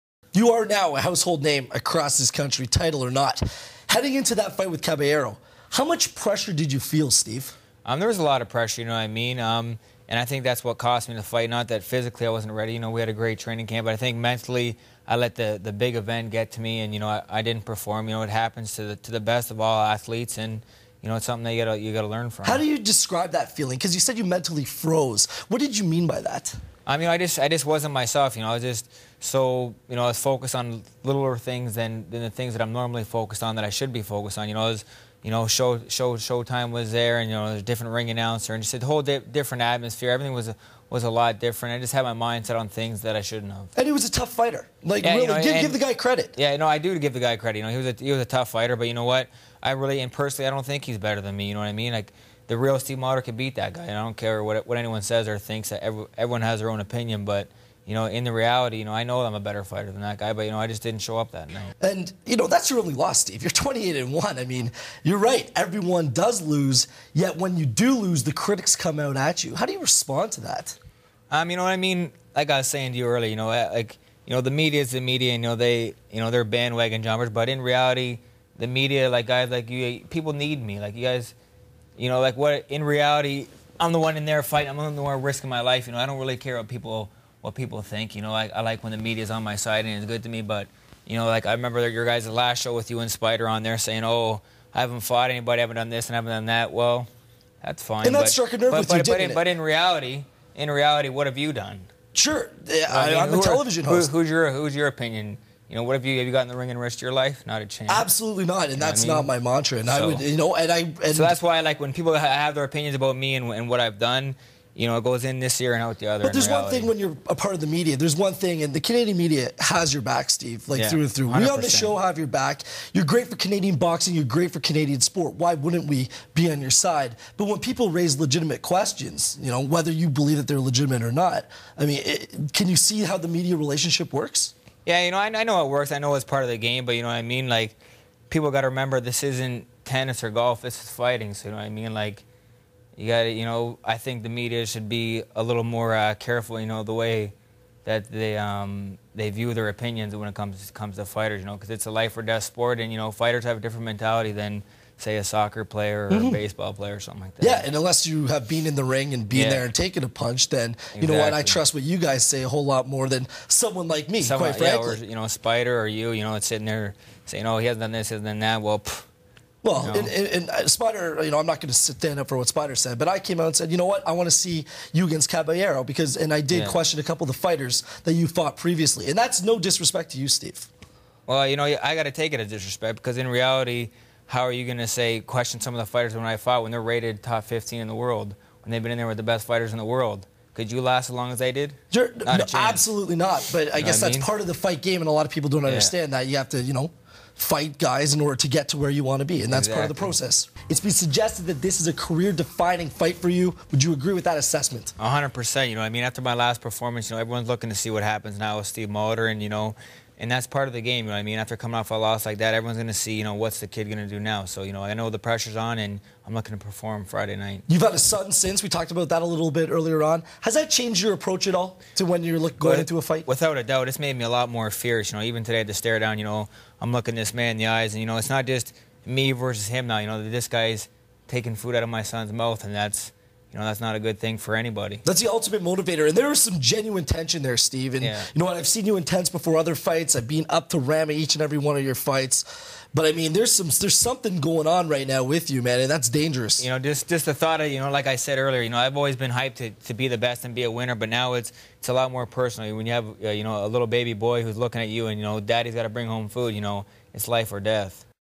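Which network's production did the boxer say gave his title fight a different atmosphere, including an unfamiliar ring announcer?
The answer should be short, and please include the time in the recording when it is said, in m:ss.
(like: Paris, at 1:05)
Showtime, at 0:36.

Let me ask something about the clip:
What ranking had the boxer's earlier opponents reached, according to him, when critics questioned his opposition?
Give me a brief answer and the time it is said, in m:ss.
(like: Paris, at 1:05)
top 15 in the world, at 3:07.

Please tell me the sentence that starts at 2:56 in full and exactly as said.
question a couple of the fighters that you fought previously, and that's no disrespect to you, Steve.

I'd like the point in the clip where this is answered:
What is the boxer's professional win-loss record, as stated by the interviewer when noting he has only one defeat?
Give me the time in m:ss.
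1:03.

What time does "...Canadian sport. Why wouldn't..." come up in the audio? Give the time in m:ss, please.
2:04.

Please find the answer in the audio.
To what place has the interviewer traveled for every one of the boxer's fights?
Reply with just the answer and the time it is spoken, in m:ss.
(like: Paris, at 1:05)
Rama, at 4:00.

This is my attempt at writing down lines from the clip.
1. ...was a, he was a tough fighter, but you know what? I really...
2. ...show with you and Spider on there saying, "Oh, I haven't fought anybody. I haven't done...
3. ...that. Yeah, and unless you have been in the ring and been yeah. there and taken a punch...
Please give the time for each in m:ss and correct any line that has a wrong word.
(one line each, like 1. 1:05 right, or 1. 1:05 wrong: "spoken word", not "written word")
1. 0:47 right
2. 1:32 right
3. 2:37 right.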